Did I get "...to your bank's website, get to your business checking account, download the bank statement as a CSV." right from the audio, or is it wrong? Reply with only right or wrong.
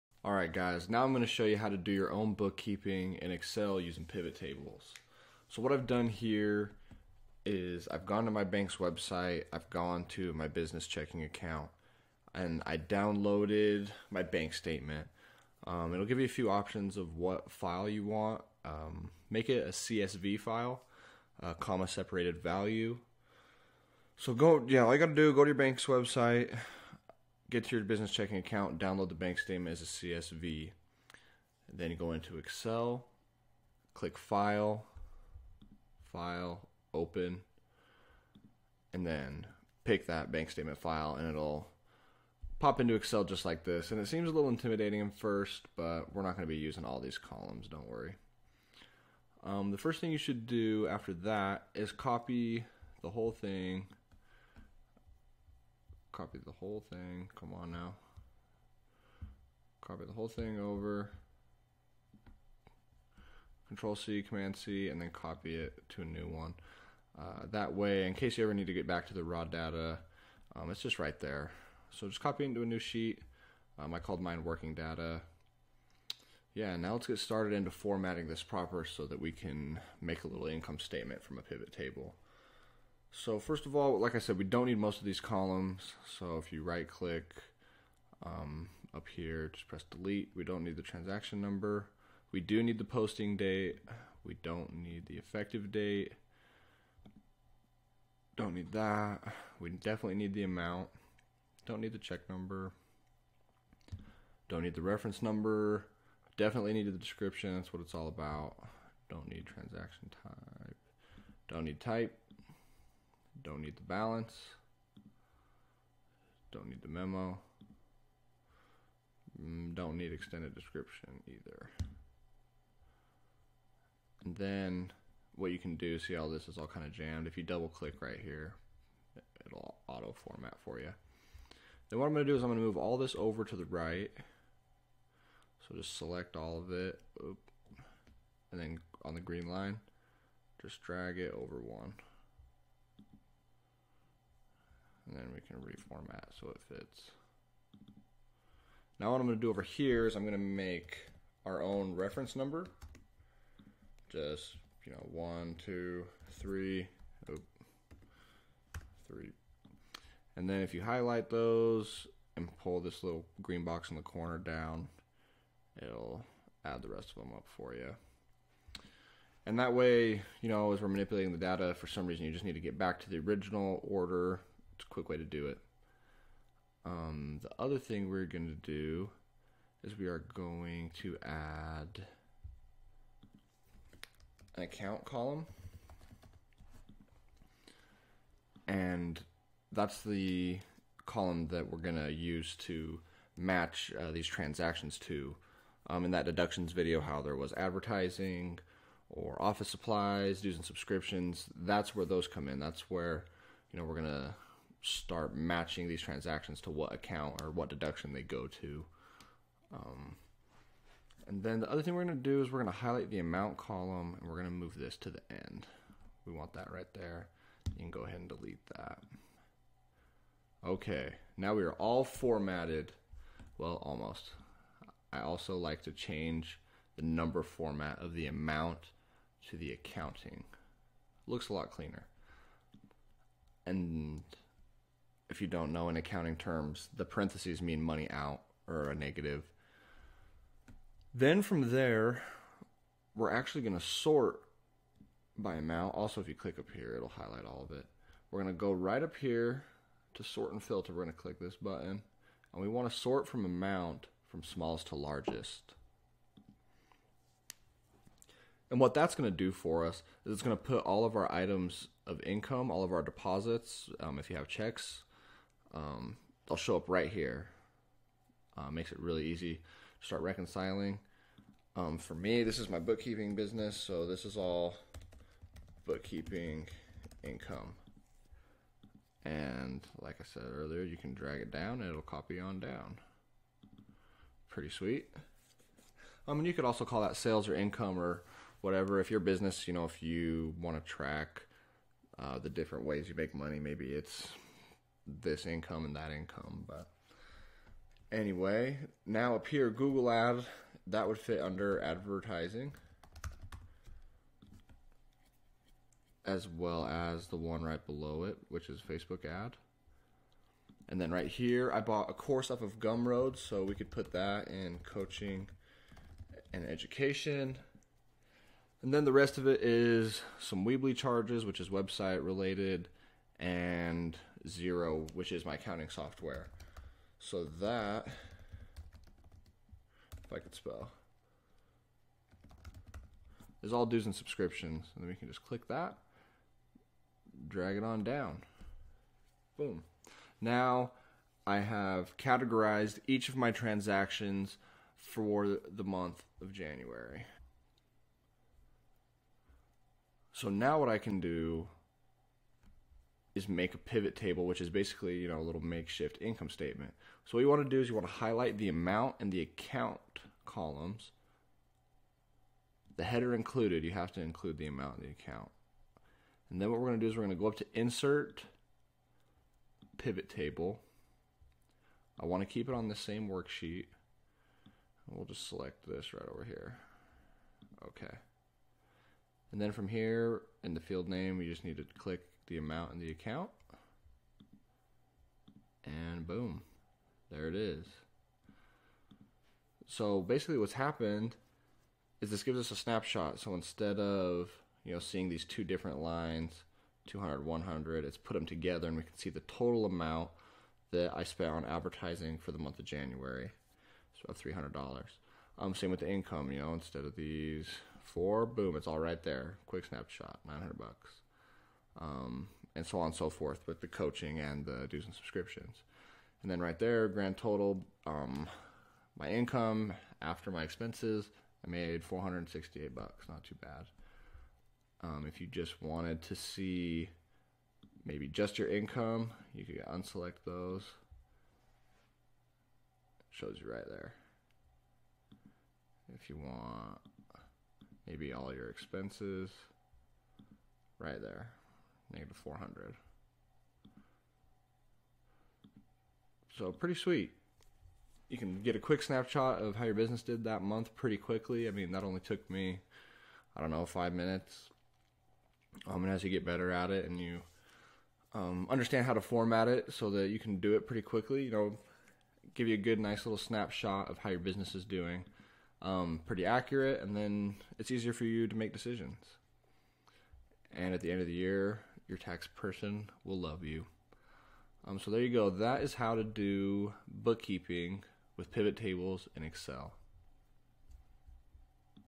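right.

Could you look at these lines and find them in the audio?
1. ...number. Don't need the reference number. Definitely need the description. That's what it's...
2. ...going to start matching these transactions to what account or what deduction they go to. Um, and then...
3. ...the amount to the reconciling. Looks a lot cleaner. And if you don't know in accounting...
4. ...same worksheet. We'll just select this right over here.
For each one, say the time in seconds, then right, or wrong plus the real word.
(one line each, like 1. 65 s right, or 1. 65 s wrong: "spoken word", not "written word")
1. 102 s right
2. 203 s right
3. 228 s wrong: "accounting", not "reconciling"
4. 372 s right.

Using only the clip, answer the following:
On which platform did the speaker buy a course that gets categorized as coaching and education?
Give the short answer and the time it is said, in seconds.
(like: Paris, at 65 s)
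Gumroad, at 312 s.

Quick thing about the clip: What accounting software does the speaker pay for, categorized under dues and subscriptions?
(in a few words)
Xero.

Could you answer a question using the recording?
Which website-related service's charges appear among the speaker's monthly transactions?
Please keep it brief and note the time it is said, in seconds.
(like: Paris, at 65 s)
Weebly, at 320 s.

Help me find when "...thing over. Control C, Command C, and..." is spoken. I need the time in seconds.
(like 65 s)
60 s.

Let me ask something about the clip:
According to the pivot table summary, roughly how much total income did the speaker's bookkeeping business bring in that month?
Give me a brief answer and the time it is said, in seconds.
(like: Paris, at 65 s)
$900, at 410 s.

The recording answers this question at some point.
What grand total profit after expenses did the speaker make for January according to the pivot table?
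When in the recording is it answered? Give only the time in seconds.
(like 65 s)
422 s.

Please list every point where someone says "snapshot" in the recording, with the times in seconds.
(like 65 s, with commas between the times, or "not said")
392 s, 409 s, 449 s, 463 s.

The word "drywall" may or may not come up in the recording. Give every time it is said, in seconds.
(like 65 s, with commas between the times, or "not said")
not said.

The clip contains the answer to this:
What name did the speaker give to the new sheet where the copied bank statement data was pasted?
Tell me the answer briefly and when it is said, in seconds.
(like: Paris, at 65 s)
working data, at 74 s.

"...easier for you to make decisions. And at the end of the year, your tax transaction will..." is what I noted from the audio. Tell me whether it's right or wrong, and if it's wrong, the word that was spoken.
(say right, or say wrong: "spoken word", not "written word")
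wrong: "person", not "transaction".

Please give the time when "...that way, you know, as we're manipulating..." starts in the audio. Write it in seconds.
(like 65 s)
169 s.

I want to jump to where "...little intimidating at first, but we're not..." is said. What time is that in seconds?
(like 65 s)
44 s.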